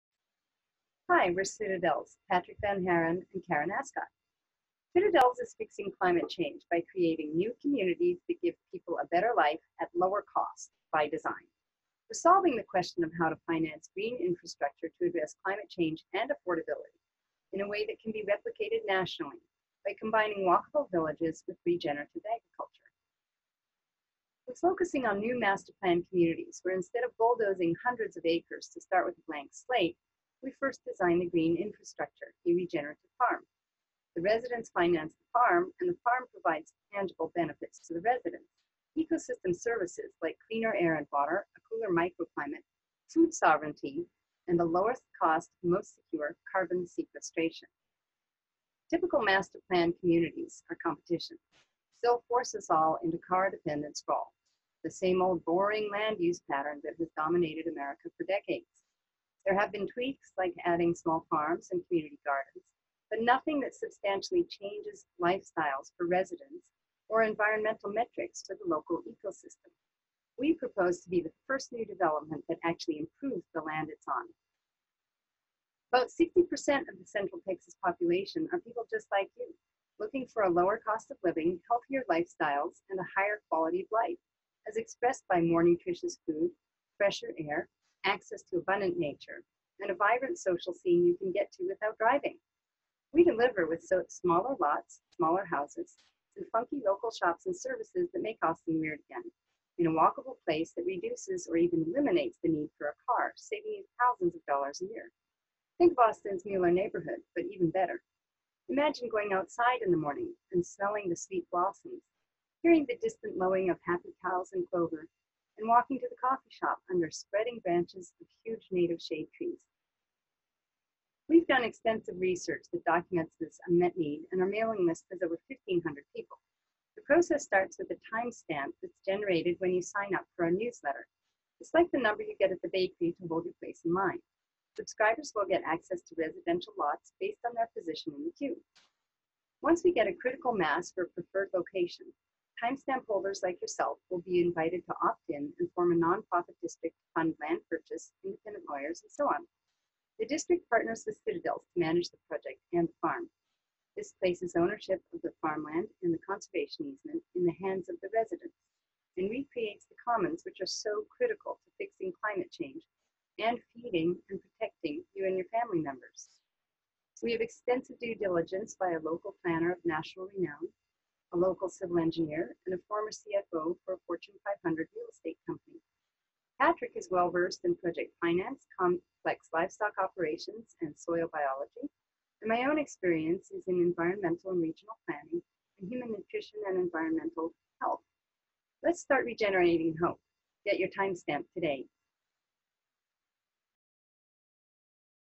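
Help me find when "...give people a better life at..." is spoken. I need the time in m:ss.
0:08.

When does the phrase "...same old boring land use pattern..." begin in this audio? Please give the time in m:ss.
0:54.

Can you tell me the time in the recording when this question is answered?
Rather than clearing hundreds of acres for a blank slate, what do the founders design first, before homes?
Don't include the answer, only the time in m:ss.
0:32.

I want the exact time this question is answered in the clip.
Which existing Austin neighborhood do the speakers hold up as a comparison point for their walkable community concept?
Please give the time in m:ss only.
1:46.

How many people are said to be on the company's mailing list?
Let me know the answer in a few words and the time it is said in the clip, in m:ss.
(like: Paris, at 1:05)
over 1,500, at 2:05.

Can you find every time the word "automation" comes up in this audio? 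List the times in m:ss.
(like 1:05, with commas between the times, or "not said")
not said.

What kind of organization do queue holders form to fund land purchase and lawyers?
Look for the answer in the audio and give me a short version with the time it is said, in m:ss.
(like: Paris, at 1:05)
nonprofit district, at 2:25.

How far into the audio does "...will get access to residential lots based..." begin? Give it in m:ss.
2:15.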